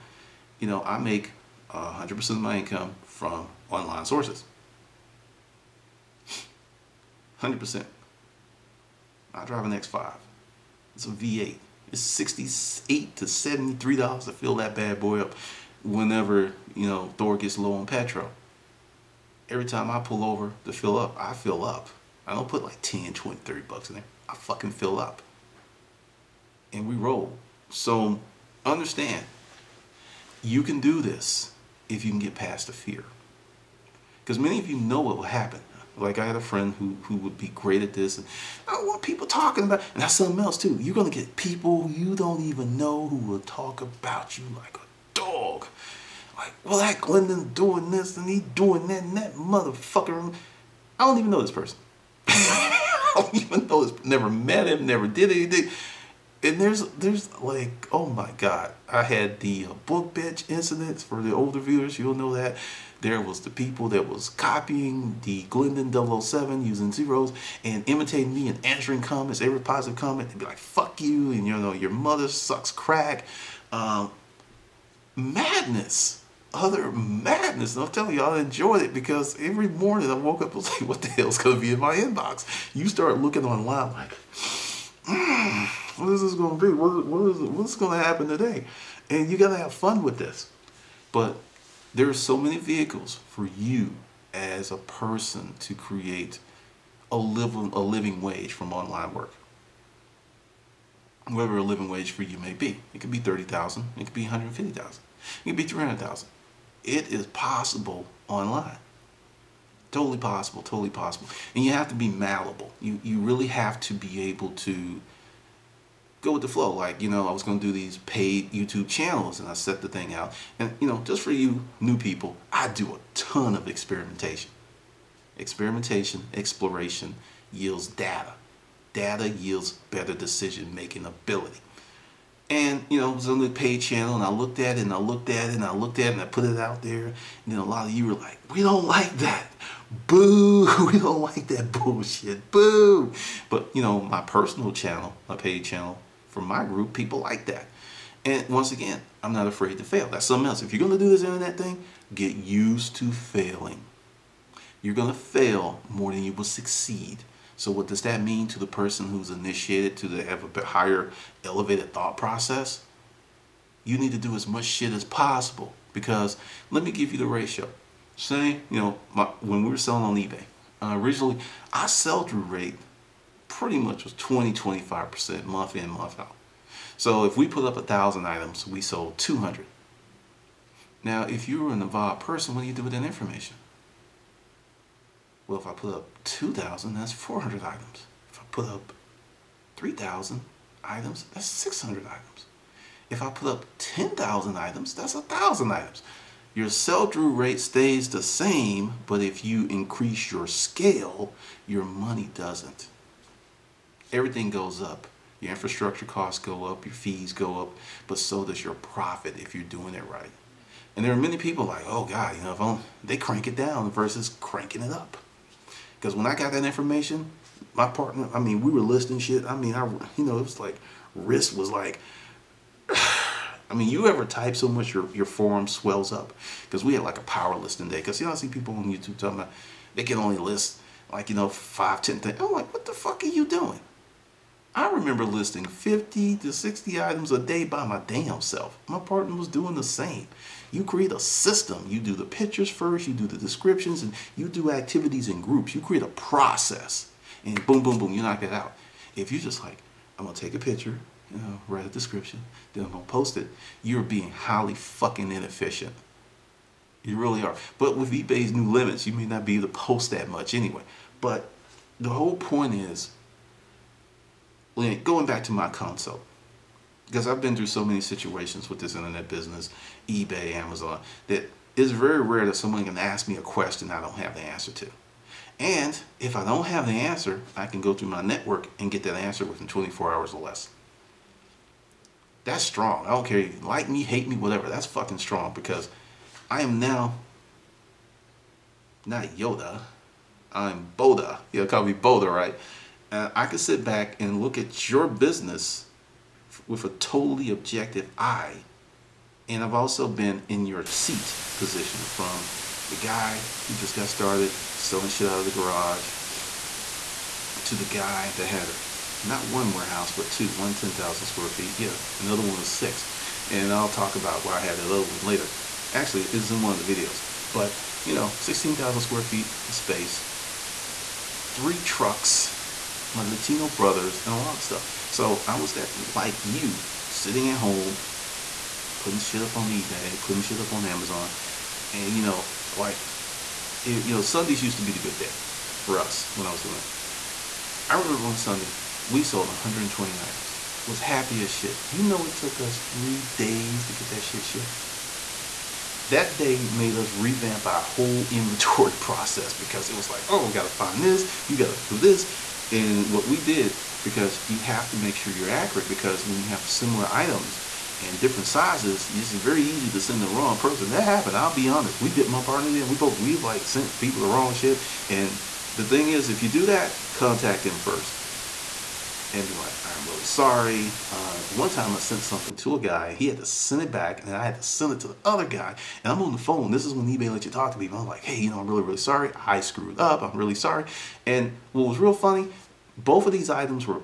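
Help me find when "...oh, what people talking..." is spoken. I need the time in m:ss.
0:38.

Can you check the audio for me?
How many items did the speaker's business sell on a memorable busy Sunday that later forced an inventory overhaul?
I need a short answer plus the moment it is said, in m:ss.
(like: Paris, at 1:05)
120, at 5:39.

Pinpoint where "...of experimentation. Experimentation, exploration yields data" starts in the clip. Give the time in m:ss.
2:03.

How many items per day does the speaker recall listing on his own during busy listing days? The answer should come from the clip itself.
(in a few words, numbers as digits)
50 to 60.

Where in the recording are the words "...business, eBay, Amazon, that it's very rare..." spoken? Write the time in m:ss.
4:29.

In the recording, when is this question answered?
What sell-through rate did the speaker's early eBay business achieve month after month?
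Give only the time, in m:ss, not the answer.
2:54.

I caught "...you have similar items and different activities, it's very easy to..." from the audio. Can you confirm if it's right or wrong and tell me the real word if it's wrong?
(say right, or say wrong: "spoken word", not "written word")
wrong: "sizes", not "activities".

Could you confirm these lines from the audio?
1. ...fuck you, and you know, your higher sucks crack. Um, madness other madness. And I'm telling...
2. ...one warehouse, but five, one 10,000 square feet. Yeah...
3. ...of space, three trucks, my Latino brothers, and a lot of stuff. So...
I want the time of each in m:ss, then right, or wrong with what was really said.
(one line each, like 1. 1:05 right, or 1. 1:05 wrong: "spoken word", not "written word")
1. 1:10 wrong: "mother", not "higher"
2. 5:09 wrong: "two", not "five"
3. 5:19 right.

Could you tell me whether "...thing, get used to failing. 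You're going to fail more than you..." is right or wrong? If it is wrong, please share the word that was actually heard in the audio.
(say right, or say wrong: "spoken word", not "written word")
right.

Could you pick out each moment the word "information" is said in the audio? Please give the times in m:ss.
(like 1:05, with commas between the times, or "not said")
3:03, 3:36.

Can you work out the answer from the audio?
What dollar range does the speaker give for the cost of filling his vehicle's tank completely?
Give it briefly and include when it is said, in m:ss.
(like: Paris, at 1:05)
68 to 73 dollars, at 0:12.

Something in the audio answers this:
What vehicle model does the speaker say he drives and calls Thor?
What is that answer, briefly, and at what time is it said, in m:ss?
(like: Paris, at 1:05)
X5, at 0:09.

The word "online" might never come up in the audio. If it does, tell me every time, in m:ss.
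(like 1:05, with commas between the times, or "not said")
0:03, 1:23, 1:38, 1:48.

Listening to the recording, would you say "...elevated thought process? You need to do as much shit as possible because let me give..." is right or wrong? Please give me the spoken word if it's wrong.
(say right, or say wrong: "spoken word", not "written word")
right.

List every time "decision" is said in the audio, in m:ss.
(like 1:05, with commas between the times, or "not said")
2:10.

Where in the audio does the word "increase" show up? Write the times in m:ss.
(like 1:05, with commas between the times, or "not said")
3:19.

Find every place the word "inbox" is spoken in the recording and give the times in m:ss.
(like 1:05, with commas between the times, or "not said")
1:21.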